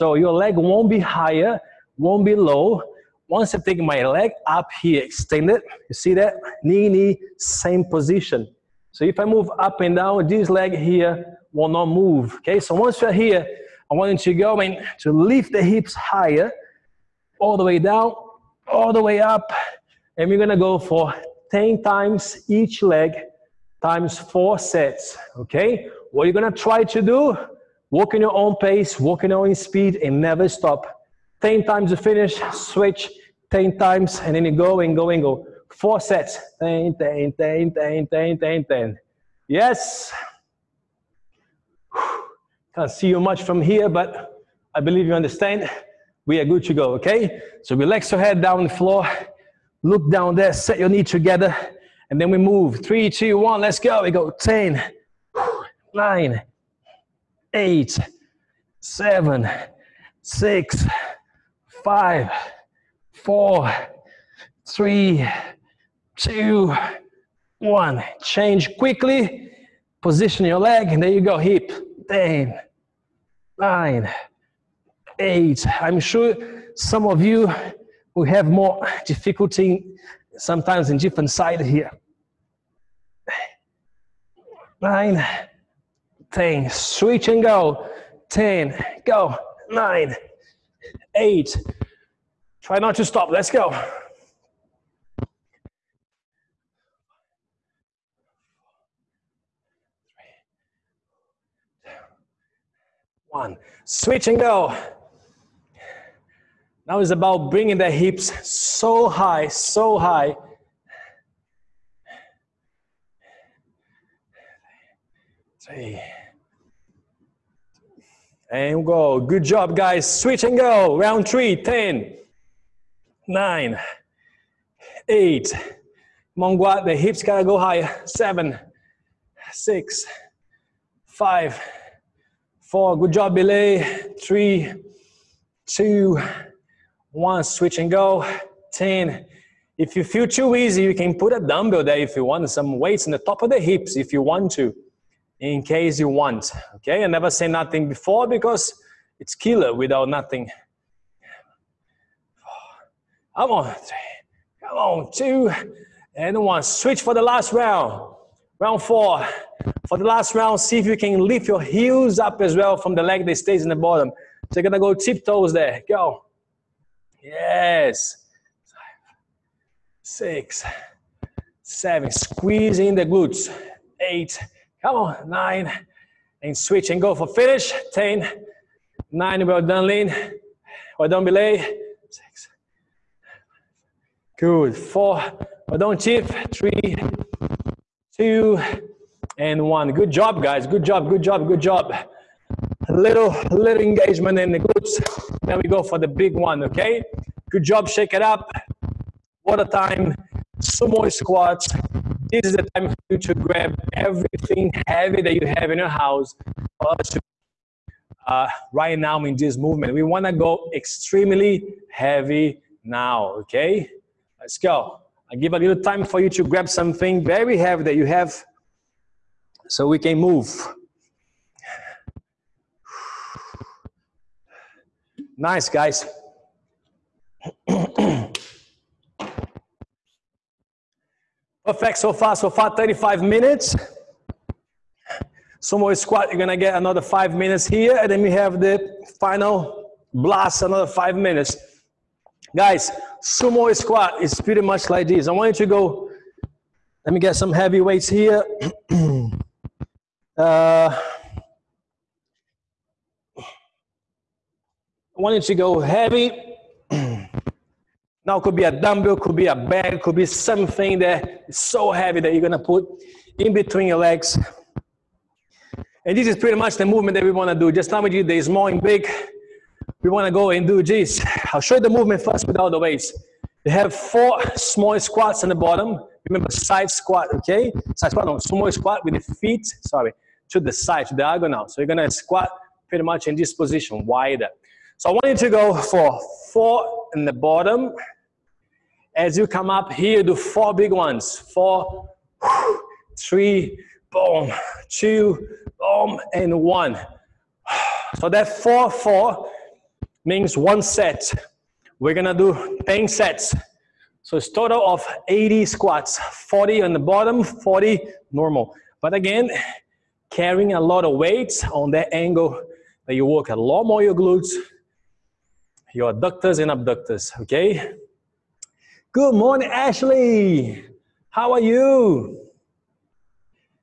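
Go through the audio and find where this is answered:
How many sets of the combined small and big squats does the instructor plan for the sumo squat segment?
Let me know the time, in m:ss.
5:02.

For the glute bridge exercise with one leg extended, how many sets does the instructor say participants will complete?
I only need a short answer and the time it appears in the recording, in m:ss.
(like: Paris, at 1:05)
4, at 0:23.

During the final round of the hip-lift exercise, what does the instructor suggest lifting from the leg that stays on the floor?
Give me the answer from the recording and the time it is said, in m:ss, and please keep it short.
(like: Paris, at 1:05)
heels, at 2:41.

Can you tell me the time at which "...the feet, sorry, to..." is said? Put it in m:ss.
4:39.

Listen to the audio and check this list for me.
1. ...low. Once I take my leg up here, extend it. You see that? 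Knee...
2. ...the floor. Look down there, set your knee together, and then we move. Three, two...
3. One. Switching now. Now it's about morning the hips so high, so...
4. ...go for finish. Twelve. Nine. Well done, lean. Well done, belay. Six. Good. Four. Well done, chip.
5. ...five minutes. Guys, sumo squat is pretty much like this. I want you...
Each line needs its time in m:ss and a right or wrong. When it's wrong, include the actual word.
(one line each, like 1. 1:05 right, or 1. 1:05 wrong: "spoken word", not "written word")
1. 0:02 right
2. 0:48 right
3. 1:43 wrong: "bringing", not "morning"
4. 2:57 wrong: "Ten", not "Twelve"
5. 4:00 right.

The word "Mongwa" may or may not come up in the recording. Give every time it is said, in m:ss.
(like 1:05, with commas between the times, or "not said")
2:06.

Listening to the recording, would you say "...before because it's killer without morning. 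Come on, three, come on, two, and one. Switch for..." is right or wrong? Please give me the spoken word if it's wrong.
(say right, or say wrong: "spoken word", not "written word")
wrong: "nothing", not "morning".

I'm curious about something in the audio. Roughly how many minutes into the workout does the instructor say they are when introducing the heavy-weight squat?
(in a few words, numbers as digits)
35.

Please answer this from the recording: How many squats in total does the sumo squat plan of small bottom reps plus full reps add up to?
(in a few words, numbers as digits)
80.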